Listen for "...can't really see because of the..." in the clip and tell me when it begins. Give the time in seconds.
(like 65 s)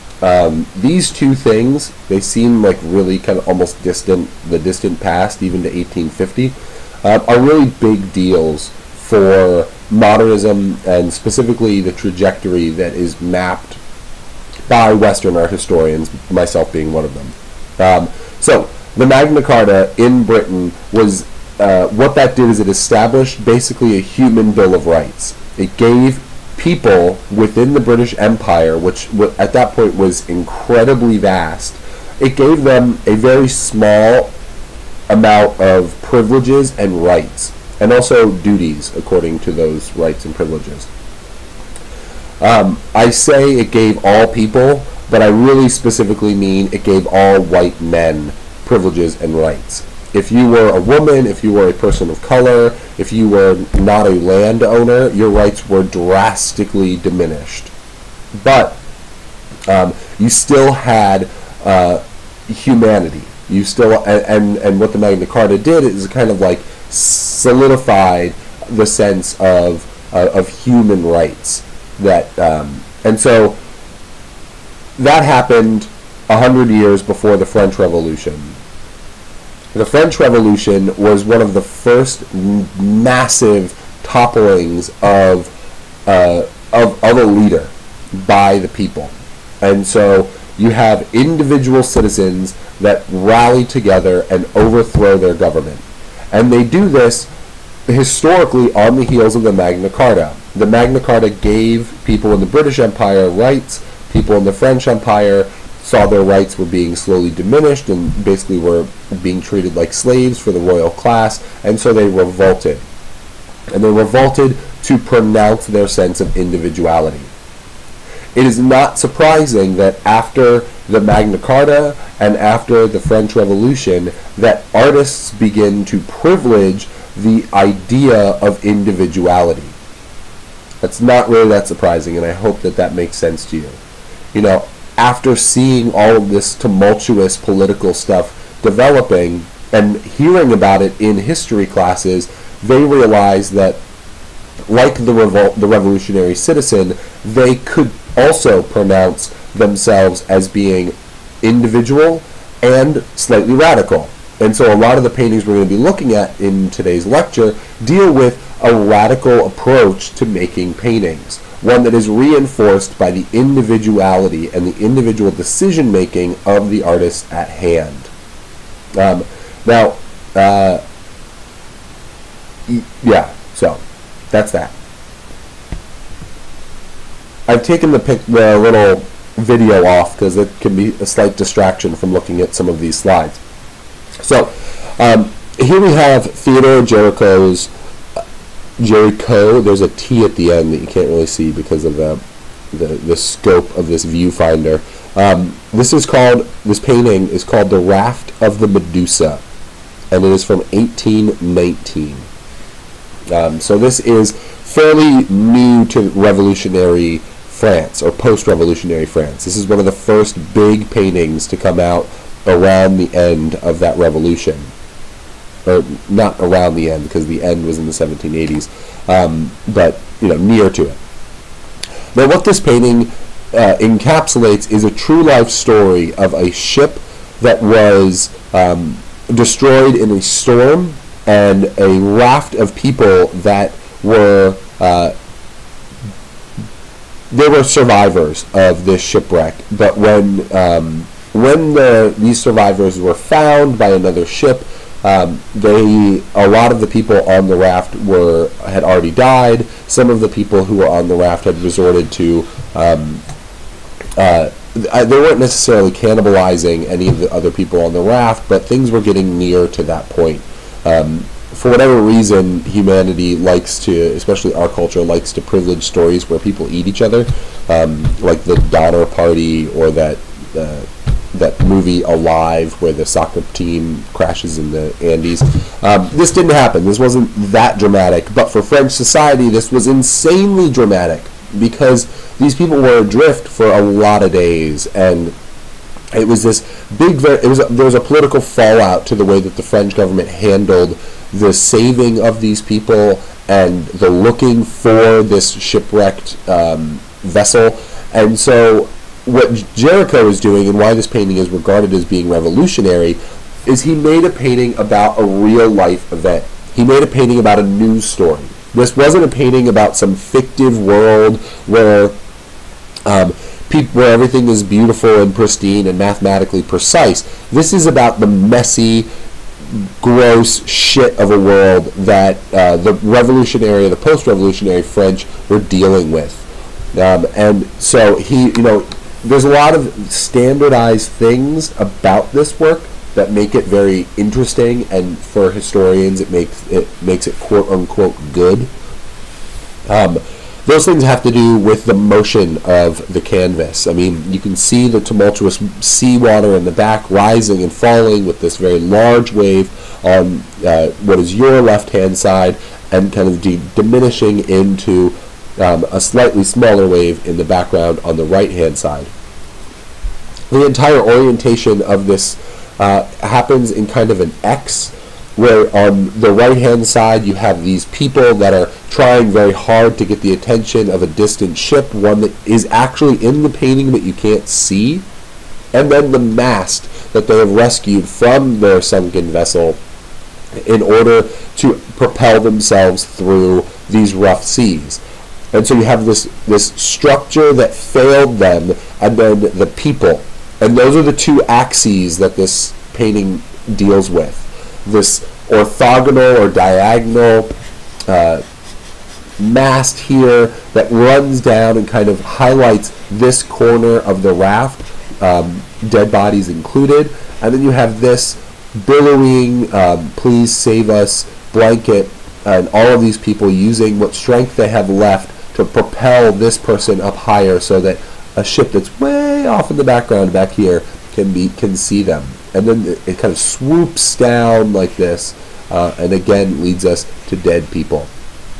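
190 s.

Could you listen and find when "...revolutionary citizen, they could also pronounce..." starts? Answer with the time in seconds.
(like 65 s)
145 s.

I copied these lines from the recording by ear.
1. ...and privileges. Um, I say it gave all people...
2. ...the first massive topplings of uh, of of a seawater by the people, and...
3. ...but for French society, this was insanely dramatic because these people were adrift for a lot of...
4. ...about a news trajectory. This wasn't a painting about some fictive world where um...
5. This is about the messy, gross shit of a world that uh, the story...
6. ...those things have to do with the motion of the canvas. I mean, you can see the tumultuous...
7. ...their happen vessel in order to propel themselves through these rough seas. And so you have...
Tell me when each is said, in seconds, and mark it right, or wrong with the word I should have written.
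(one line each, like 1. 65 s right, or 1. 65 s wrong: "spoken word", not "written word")
1. 40 s right
2. 81 s wrong: "leader", not "seawater"
3. 278 s right
4. 307 s wrong: "story", not "trajectory"
5. 317 s wrong: "revolutionary", not "story"
6. 340 s right
7. 378 s wrong: "sunken", not "happen".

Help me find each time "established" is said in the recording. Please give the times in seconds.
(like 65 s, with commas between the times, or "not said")
22 s.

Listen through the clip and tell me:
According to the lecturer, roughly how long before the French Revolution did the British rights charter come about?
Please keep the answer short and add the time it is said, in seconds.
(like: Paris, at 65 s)
a hundred years, at 76 s.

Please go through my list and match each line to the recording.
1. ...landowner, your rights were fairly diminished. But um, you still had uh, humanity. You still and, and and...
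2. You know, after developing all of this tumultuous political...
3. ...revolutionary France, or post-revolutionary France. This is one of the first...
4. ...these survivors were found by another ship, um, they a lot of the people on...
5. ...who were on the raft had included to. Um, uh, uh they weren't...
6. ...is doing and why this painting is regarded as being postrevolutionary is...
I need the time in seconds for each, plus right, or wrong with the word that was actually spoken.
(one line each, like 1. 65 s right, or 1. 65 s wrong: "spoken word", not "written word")
1. 54 s wrong: "drastically", not "fairly"
2. 134 s wrong: "seeing", not "developing"
3. 206 s right
4. 242 s right
5. 250 s wrong: "resorted", not "included"
6. 300 s wrong: "revolutionary", not "postrevolutionary".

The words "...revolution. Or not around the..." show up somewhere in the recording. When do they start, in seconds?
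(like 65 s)
213 s.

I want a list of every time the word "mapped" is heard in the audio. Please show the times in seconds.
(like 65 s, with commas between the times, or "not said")
13 s.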